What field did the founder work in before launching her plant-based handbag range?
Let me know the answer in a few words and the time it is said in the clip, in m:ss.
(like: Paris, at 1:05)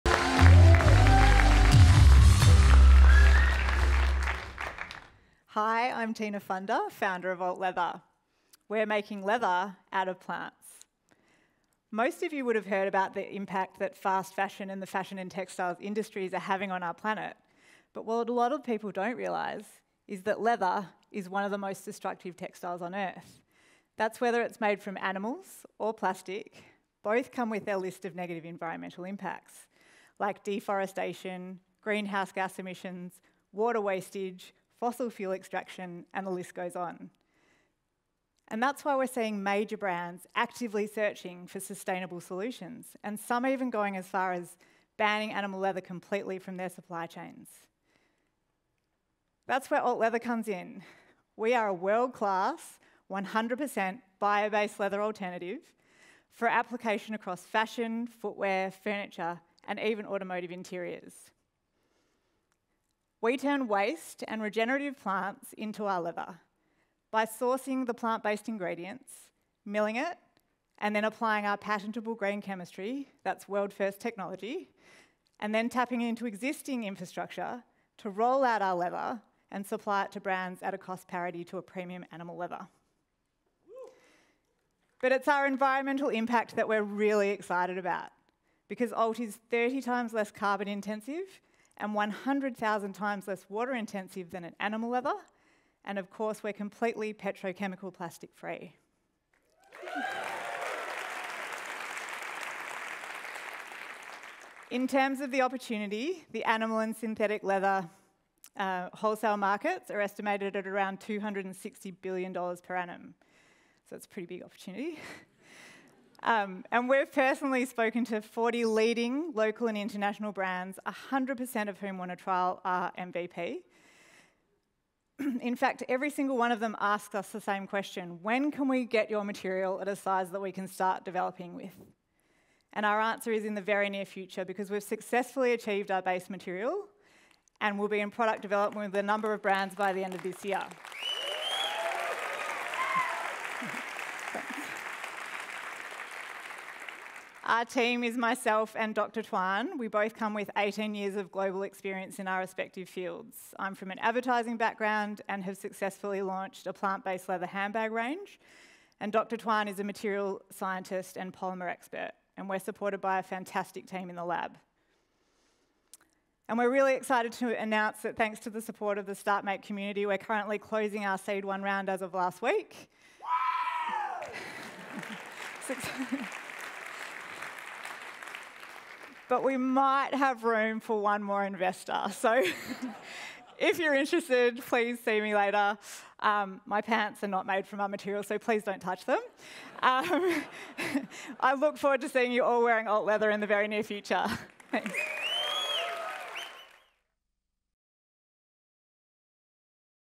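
Advertising, at 2:33.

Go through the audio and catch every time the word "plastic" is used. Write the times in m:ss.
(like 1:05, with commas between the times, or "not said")
0:25, 1:37.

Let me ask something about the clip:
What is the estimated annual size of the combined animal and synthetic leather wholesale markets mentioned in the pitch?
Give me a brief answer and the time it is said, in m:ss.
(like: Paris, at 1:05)
$260 billion, at 1:51.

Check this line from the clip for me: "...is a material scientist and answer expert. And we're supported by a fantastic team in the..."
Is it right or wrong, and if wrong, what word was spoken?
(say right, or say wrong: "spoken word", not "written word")
wrong: "polymer", not "answer".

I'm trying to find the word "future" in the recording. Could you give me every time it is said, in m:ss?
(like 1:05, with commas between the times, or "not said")
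2:14, 3:13.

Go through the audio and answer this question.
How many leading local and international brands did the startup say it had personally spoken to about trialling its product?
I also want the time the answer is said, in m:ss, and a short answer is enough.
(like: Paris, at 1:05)
40, at 1:58.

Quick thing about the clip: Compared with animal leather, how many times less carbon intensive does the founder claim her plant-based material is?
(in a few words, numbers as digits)
30 times.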